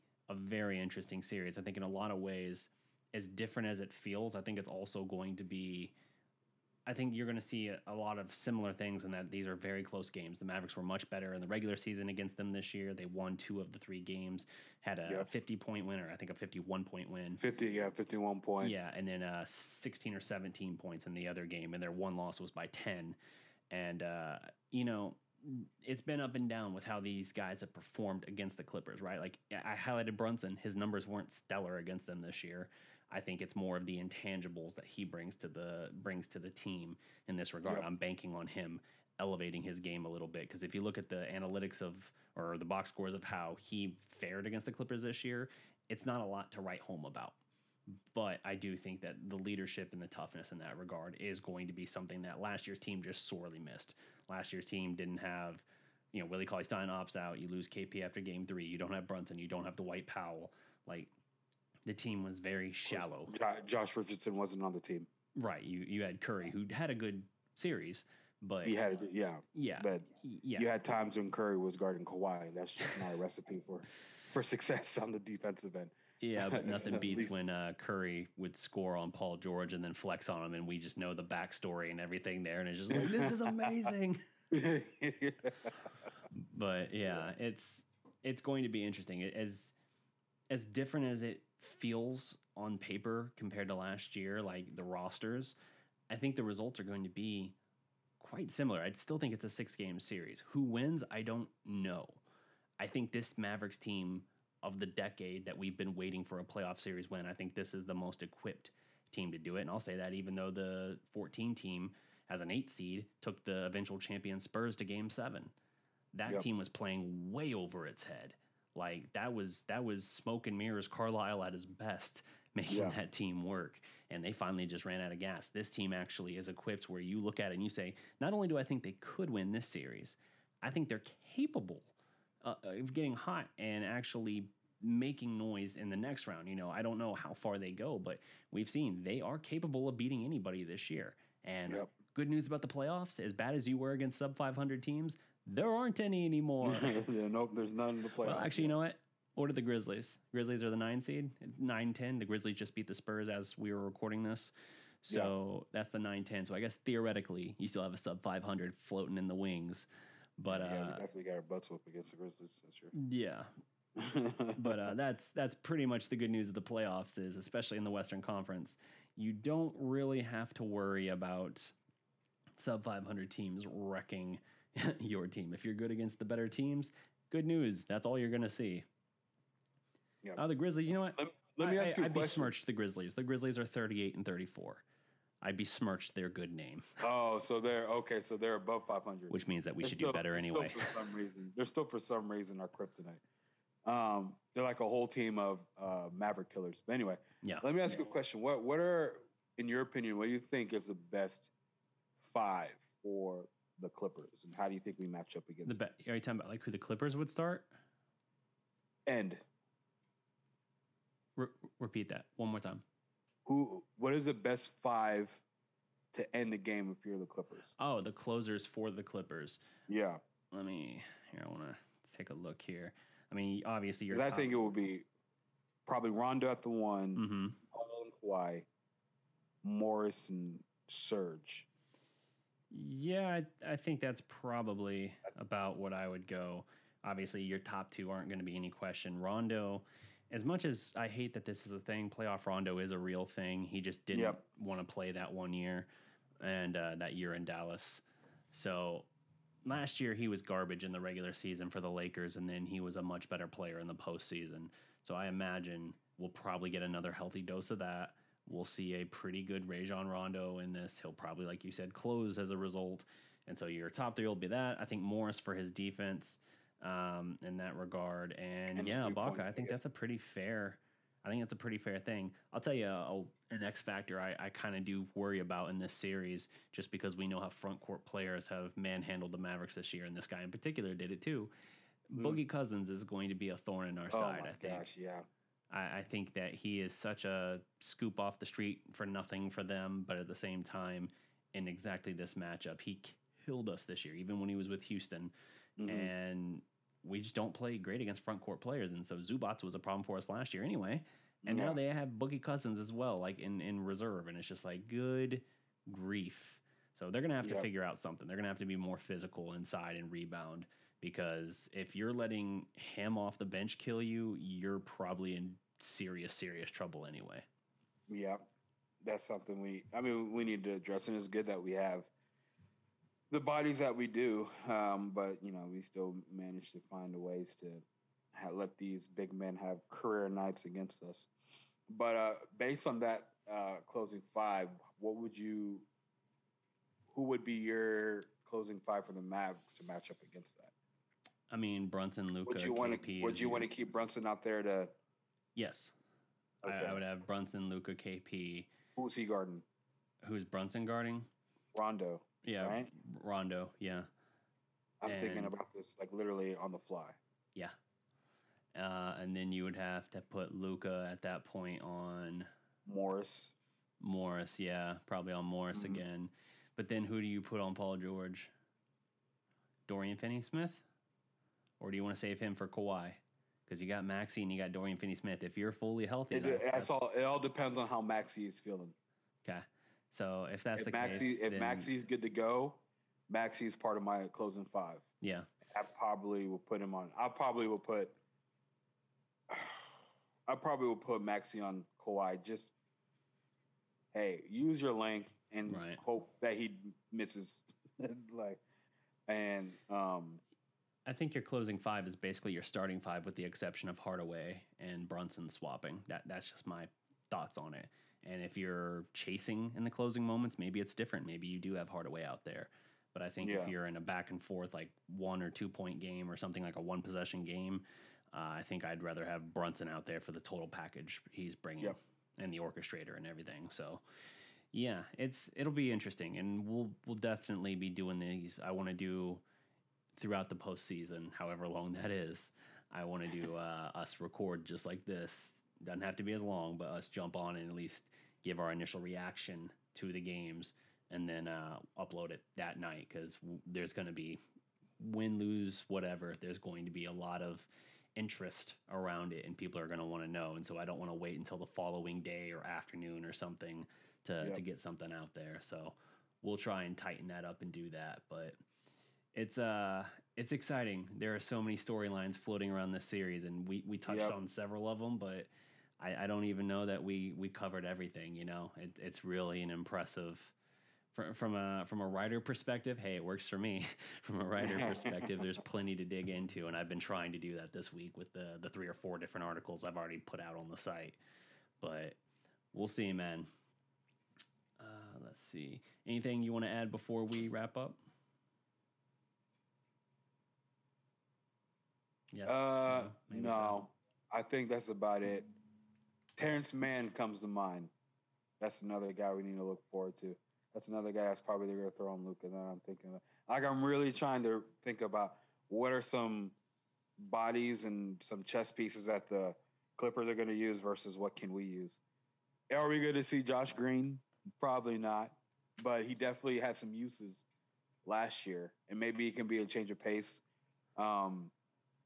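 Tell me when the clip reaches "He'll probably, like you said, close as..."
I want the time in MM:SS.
04:20.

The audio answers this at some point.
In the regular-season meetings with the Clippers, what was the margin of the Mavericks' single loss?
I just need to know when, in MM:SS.
00:21.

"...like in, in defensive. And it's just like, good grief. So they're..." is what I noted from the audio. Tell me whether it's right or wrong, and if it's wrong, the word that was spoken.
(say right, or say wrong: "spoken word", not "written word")
wrong: "reserve", not "defensive".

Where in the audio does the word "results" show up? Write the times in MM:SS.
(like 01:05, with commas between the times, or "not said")
01:36, 04:22.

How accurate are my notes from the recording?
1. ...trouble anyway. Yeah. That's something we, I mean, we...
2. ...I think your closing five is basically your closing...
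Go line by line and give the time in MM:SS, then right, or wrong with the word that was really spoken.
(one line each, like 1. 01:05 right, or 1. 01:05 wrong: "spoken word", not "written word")
1. 05:16 right
2. 06:41 wrong: "starting", not "closing".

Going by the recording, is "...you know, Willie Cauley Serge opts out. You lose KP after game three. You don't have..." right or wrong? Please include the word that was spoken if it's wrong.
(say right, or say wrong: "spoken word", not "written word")
wrong: "Stein", not "Serge".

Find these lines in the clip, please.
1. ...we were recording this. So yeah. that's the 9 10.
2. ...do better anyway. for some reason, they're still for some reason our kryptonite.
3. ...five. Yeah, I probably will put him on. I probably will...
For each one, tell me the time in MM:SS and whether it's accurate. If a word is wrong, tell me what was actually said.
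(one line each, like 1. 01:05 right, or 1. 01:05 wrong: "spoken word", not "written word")
1. 02:33 right
2. 03:10 right
3. 06:24 right.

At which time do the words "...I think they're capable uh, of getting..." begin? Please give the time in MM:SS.
02:10.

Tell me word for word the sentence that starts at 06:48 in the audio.
And if you're chasing in the closing moments, maybe it's different.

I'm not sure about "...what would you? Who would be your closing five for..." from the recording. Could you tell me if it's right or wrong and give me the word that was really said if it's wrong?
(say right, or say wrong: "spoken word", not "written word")
right.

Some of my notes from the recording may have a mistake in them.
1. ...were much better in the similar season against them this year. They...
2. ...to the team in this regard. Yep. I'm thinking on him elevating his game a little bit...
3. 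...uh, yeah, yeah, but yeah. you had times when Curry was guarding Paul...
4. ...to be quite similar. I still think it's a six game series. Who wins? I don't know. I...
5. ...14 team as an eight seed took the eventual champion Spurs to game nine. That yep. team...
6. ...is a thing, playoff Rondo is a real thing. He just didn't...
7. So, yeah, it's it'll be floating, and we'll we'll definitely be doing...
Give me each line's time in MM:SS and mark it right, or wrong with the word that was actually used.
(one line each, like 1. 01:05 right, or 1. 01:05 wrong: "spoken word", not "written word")
1. 00:10 wrong: "regular", not "similar"
2. 00:36 wrong: "banking", not "thinking"
3. 01:09 wrong: "Kawhi", not "Paul"
4. 01:37 right
5. 01:51 wrong: "seven", not "nine"
6. 04:01 right
7. 07:03 wrong: "interesting", not "floating".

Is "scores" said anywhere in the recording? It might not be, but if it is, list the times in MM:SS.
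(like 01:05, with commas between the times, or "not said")
00:42, 01:18.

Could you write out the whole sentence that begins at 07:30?
And so I don't want to wait until the following day or afternoon or something to, yep.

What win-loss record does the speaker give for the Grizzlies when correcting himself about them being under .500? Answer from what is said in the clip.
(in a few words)
38 and 34.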